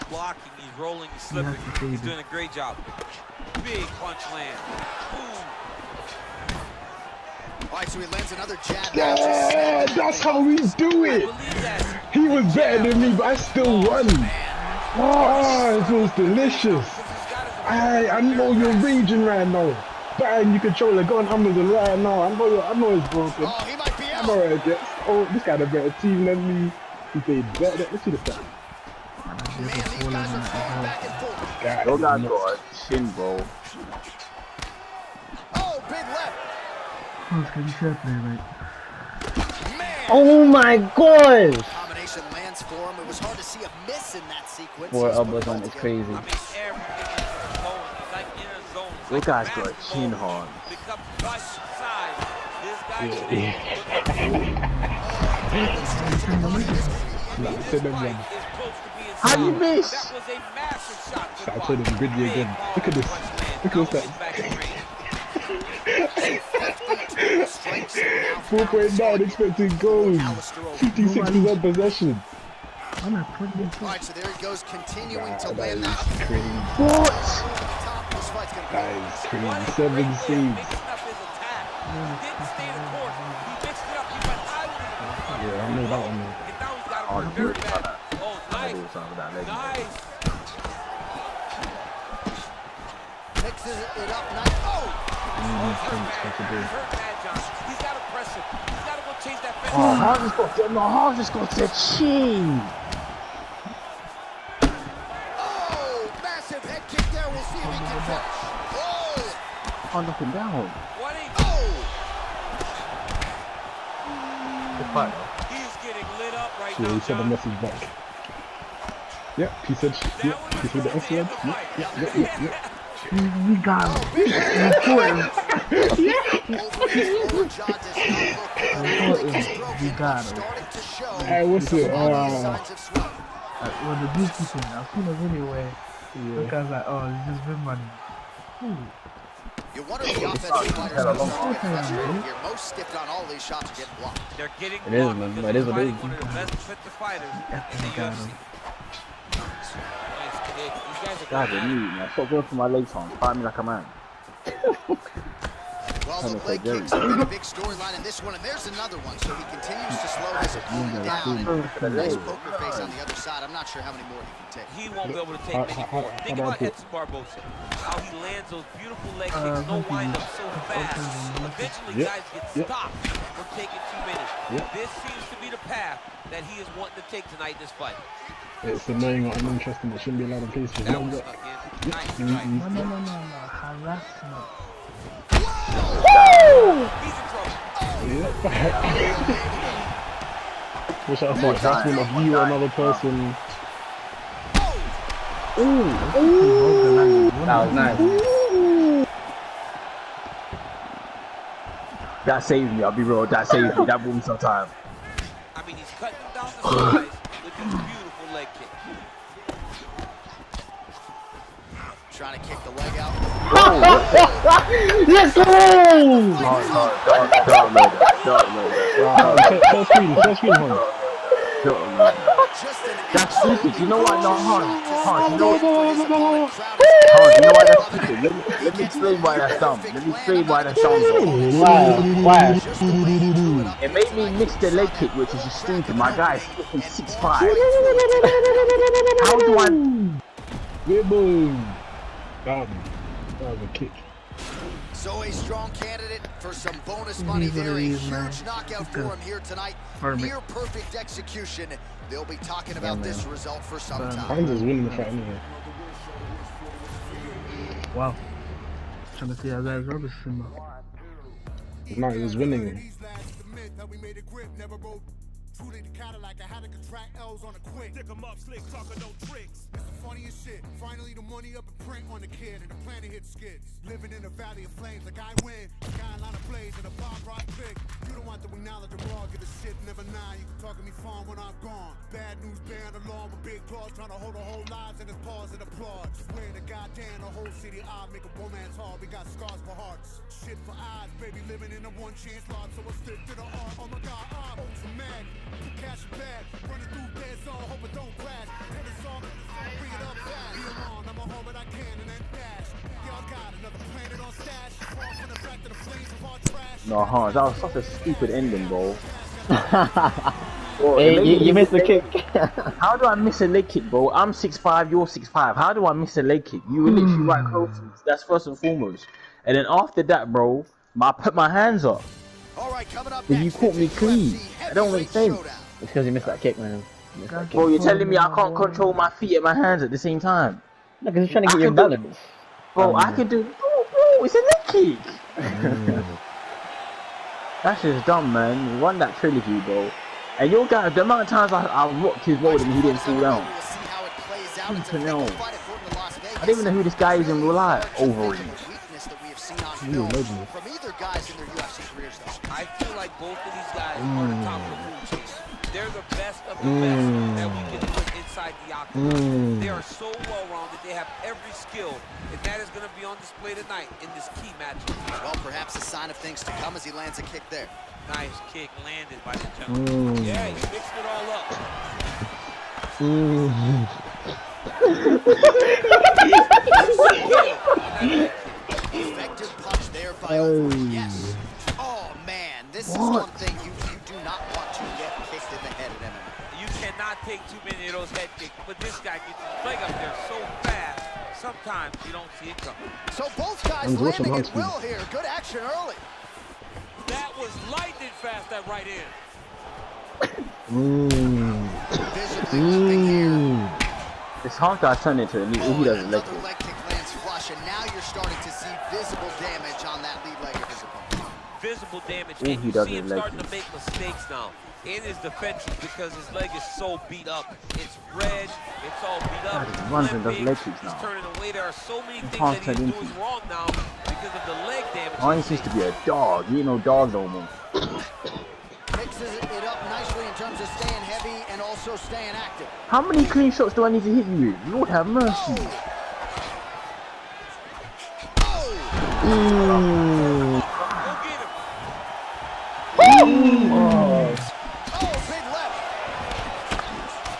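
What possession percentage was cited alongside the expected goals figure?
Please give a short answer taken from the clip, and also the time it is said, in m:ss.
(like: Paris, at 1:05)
56 percent, at 1:10.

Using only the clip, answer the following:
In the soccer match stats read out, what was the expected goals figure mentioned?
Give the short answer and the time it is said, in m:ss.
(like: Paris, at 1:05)
4.9, at 1:08.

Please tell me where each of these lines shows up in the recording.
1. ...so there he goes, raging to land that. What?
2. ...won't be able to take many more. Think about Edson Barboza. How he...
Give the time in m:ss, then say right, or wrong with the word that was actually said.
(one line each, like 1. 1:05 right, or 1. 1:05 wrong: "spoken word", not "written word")
1. 1:14 wrong: "continuing", not "raging"
2. 2:44 right.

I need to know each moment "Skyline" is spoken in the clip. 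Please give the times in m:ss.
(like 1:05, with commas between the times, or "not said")
4:35.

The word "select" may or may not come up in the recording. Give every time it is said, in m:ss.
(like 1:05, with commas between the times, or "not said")
not said.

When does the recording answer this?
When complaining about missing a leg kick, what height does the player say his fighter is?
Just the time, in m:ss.
3:56.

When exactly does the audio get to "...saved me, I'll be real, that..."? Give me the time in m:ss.
3:22.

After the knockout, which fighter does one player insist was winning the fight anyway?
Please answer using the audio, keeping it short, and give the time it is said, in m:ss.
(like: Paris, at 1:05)
Hines, at 4:14.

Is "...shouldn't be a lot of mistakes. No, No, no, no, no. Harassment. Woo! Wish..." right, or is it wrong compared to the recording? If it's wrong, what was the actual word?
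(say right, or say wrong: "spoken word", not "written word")
wrong: "pieces", not "mistakes".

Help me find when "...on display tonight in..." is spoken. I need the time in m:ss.
6:03.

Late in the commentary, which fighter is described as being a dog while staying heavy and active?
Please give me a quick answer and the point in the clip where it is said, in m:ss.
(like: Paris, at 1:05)
Ryan, at 7:05.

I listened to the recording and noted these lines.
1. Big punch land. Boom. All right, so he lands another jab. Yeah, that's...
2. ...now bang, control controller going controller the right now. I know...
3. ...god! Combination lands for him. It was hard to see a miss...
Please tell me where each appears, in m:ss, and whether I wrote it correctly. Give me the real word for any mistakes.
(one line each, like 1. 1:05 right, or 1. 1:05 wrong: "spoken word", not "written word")
1. 0:03 right
2. 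0:19 wrong: "under", not "controller"
3. 0:40 right.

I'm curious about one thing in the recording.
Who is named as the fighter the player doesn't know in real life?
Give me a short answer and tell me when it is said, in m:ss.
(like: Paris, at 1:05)
Overeem, at 5:47.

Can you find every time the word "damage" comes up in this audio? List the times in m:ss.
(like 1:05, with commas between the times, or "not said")
6:52, 7:04.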